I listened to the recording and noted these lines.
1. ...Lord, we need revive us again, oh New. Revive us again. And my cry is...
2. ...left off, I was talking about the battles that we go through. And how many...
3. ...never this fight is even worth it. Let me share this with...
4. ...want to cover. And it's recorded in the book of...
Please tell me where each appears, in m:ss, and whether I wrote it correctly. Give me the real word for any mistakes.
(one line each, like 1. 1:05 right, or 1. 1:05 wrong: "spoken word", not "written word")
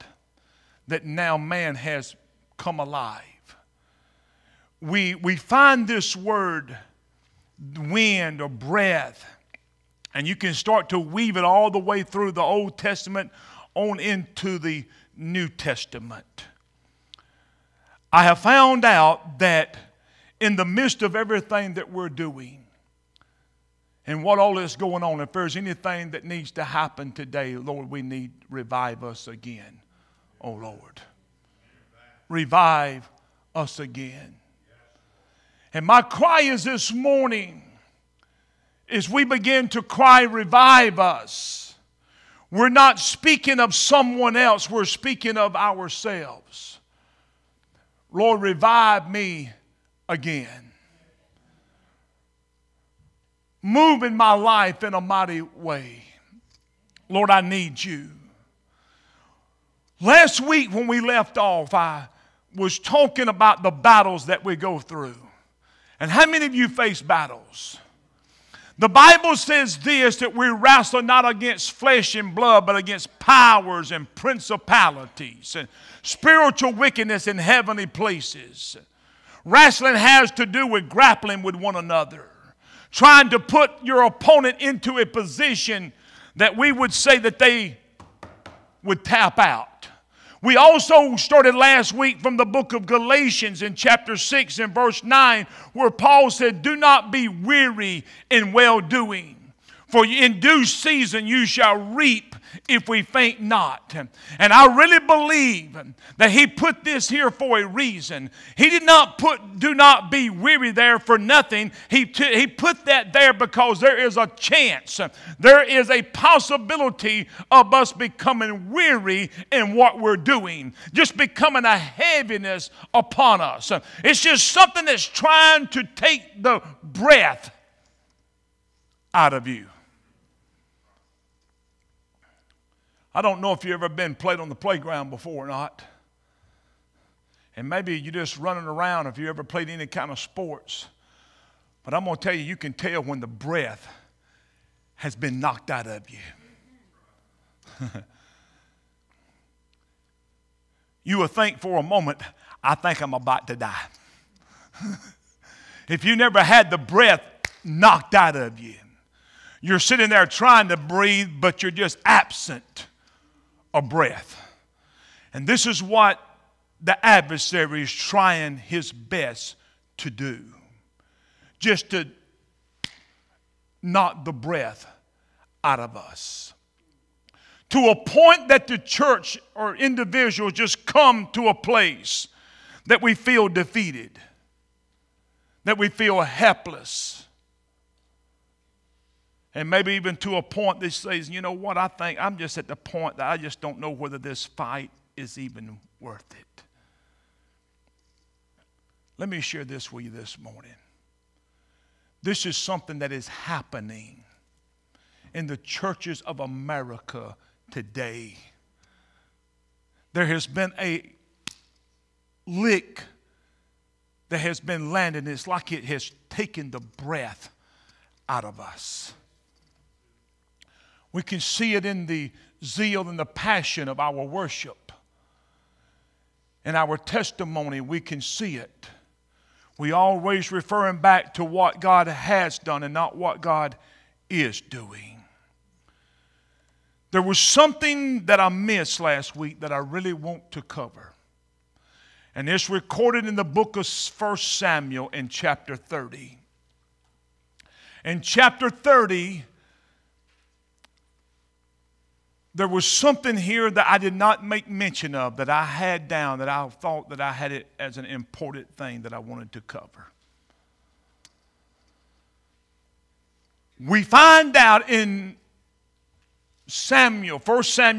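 1. 0:27 wrong: "Lord", not "New"
2. 1:00 right
3. 3:13 wrong: "whether", not "never"
4. 4:00 right.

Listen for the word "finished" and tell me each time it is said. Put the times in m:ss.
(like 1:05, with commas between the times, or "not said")
not said.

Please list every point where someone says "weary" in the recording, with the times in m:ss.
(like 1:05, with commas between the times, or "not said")
1:37, 1:50, 1:58.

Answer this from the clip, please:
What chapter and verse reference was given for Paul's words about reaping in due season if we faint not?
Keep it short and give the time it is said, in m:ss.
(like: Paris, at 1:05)
Chapter 6, verse 9, at 1:33.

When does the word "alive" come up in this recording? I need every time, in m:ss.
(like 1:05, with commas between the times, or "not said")
0:02.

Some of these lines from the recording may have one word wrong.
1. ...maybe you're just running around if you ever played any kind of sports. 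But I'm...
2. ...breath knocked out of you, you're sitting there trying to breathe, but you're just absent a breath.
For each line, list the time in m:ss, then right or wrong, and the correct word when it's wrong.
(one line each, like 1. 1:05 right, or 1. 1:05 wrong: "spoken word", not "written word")
1. 2:17 right
2. 2:36 right.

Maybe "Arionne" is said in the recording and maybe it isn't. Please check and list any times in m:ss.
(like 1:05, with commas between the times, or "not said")
not said.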